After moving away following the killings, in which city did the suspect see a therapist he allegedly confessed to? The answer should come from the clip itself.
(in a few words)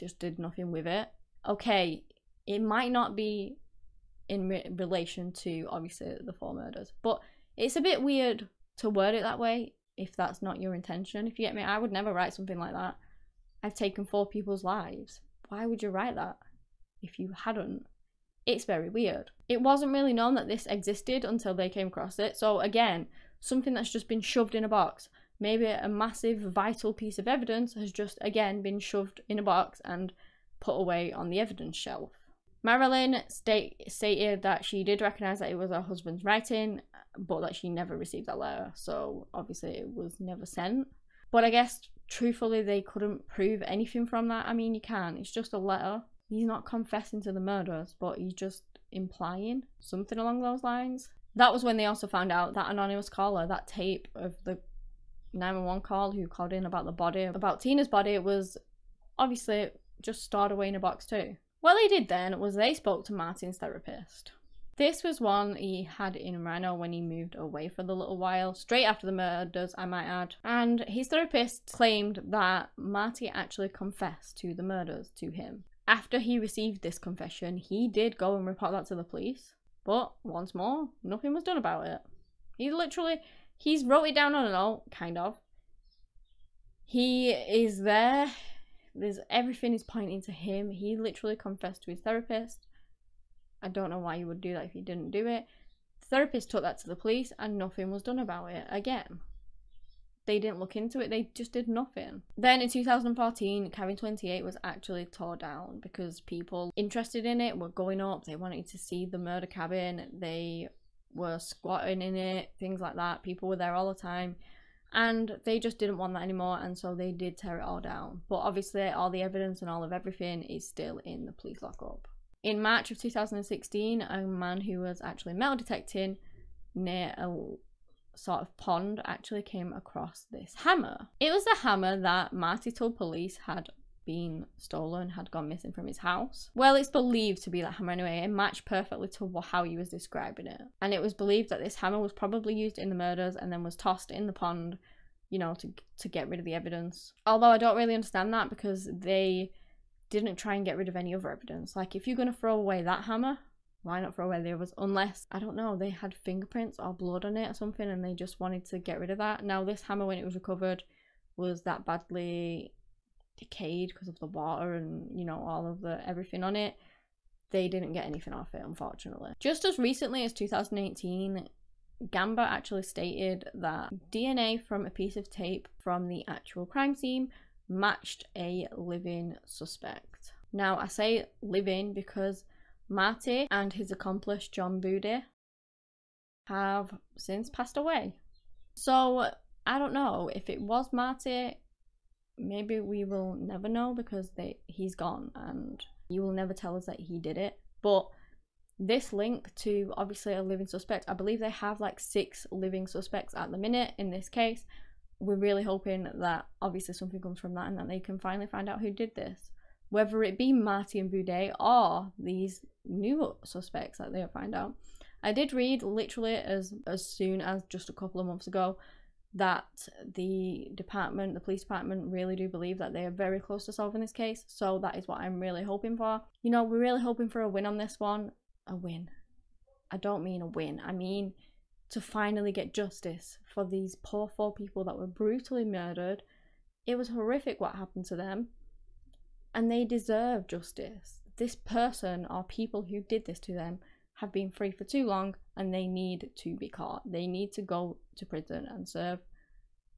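Reno.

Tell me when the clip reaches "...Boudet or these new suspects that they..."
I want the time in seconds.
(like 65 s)
211 s.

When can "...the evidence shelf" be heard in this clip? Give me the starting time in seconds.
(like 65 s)
31 s.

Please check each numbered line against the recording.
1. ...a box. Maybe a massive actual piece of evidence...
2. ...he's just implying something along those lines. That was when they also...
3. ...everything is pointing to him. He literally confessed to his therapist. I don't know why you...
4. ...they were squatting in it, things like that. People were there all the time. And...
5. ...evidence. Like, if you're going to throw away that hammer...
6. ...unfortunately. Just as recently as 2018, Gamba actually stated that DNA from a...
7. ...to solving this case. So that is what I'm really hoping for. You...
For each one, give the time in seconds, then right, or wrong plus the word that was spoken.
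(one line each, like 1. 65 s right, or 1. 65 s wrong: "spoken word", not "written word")
1. 24 s wrong: "vital", not "actual"
2. 48 s right
3. 89 s right
4. 110 s right
5. 151 s right
6. 168 s right
7. 223 s right.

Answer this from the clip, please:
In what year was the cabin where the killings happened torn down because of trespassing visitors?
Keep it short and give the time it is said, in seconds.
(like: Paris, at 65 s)
2014, at 102 s.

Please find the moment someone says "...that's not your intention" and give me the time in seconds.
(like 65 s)
10 s.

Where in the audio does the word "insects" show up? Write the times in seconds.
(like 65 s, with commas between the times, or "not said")
not said.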